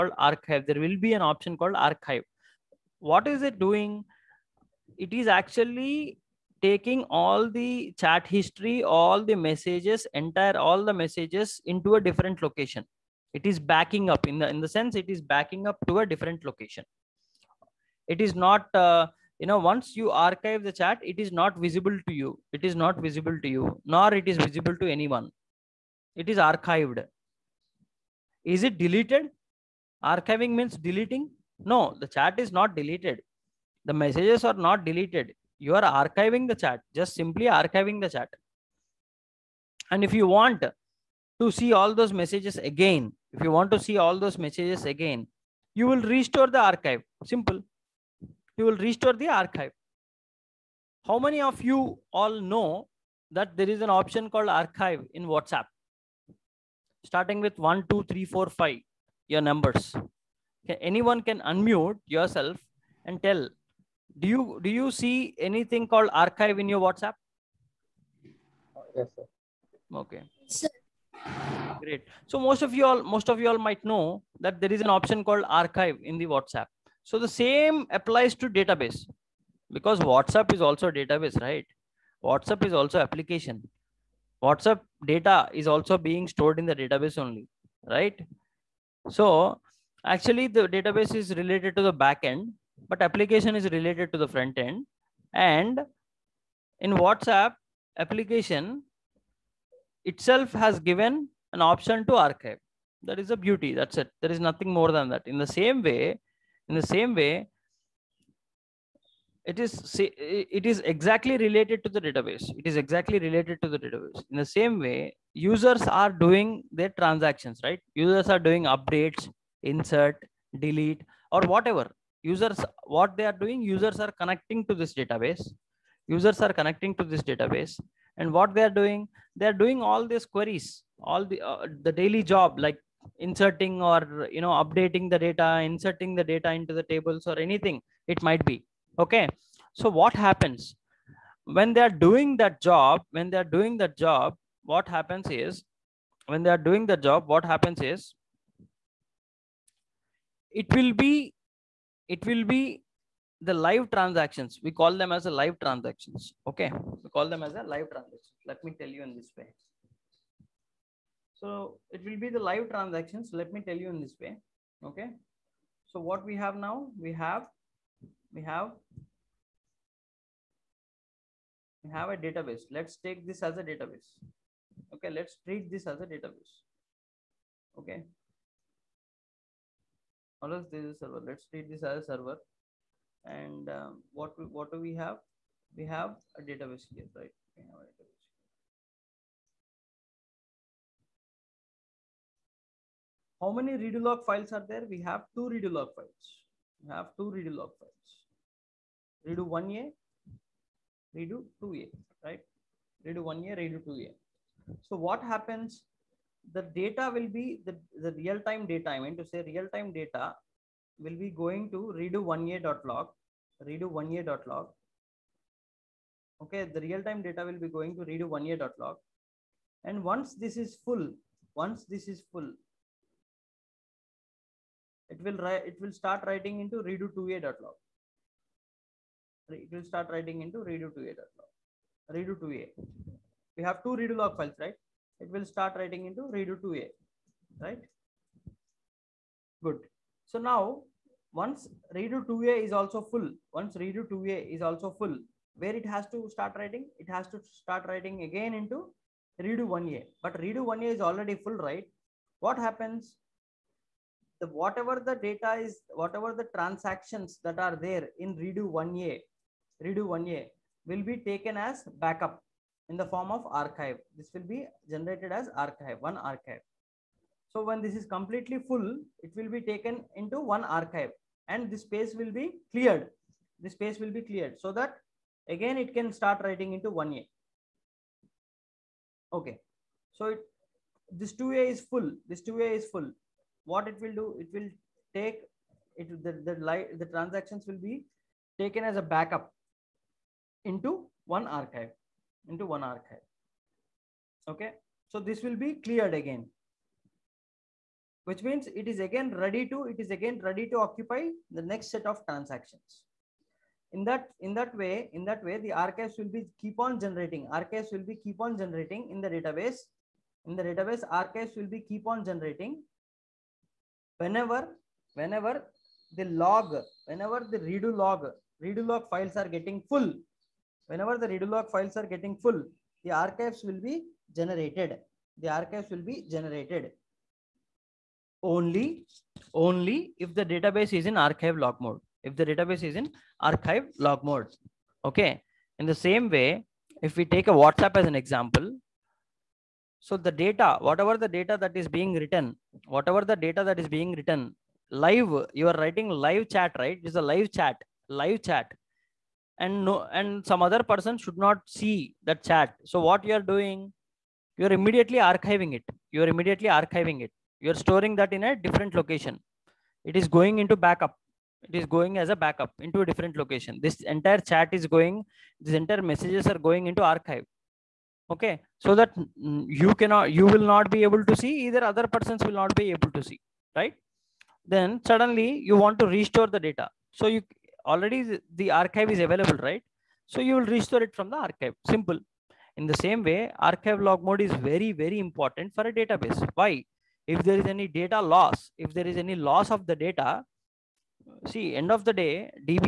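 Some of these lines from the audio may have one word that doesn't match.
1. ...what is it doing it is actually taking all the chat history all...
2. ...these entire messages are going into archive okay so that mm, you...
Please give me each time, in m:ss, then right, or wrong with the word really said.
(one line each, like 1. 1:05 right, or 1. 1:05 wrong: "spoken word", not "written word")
1. 0:02 right
2. 6:05 right.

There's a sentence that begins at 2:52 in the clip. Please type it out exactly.
Let's take this as a database.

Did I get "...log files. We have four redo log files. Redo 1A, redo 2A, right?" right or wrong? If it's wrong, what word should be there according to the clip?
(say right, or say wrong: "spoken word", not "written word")
wrong: "two", not "four".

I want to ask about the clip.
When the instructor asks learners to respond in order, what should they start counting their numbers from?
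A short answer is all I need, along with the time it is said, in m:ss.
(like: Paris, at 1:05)
1, at 0:57.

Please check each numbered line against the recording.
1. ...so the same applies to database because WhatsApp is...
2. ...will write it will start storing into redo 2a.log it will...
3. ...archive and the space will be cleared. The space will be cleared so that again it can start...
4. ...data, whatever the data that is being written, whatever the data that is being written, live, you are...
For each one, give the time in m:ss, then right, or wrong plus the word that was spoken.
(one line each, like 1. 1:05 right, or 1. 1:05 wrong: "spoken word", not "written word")
1. 1:17 right
2. 3:45 wrong: "writing", not "storing"
3. 4:30 right
4. 5:40 right.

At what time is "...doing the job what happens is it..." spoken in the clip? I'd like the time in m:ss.
2:26.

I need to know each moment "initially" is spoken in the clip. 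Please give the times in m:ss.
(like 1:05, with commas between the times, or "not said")
not said.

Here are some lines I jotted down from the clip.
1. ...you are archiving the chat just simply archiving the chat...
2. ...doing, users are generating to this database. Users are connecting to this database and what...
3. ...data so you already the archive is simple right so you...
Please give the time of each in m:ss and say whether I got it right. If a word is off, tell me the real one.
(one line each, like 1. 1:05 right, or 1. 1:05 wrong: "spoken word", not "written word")
1. 0:35 right
2. 2:03 wrong: "connecting", not "generating"
3. 6:16 wrong: "available", not "simple".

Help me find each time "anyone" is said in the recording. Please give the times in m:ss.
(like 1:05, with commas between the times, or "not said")
0:24, 1:00.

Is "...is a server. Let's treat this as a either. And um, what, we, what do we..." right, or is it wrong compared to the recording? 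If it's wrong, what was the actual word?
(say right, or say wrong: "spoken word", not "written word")
wrong: "server", not "either".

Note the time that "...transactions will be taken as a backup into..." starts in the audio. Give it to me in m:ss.
4:47.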